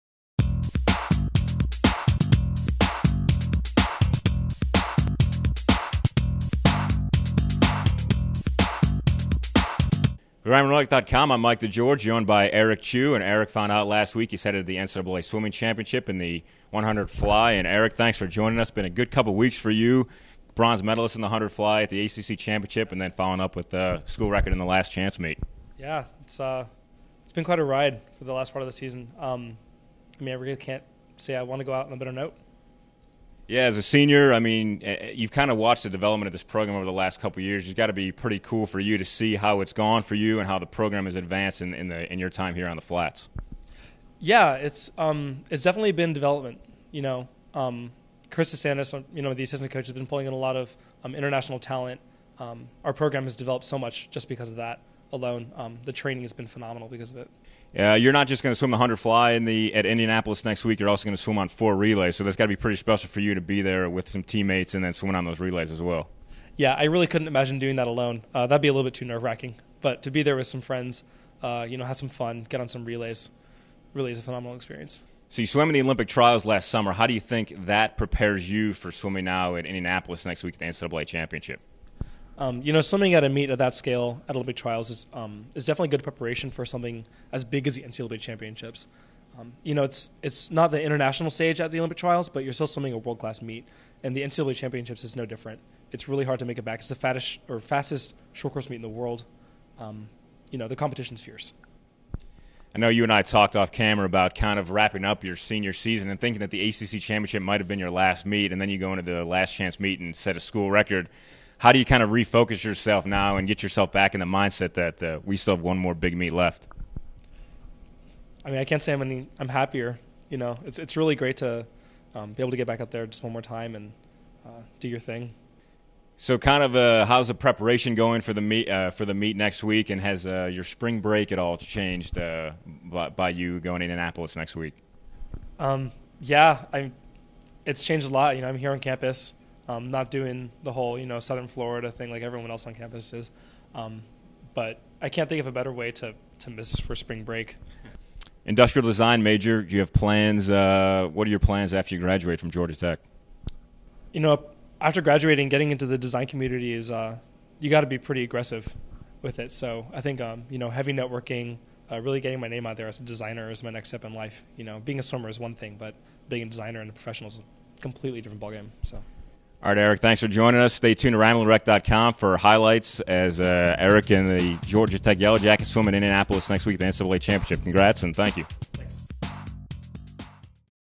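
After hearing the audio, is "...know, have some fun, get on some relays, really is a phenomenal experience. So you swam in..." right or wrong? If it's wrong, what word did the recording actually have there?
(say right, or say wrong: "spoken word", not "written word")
right.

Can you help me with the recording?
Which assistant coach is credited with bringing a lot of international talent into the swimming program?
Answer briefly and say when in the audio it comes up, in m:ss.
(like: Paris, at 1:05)
Chris DeSantis, at 0:48.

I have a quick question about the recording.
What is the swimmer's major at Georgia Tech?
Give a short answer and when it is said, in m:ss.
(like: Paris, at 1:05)
Industrial design, at 2:28.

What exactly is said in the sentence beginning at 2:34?
You know, after graduating, getting into the design community is uh, you got to be pretty aggressive with it.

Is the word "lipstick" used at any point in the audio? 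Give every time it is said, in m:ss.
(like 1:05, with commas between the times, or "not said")
not said.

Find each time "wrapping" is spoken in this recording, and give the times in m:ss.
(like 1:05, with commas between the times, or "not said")
1:44.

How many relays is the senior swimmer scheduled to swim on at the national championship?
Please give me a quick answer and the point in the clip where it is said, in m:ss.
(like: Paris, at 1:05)
4, at 1:01.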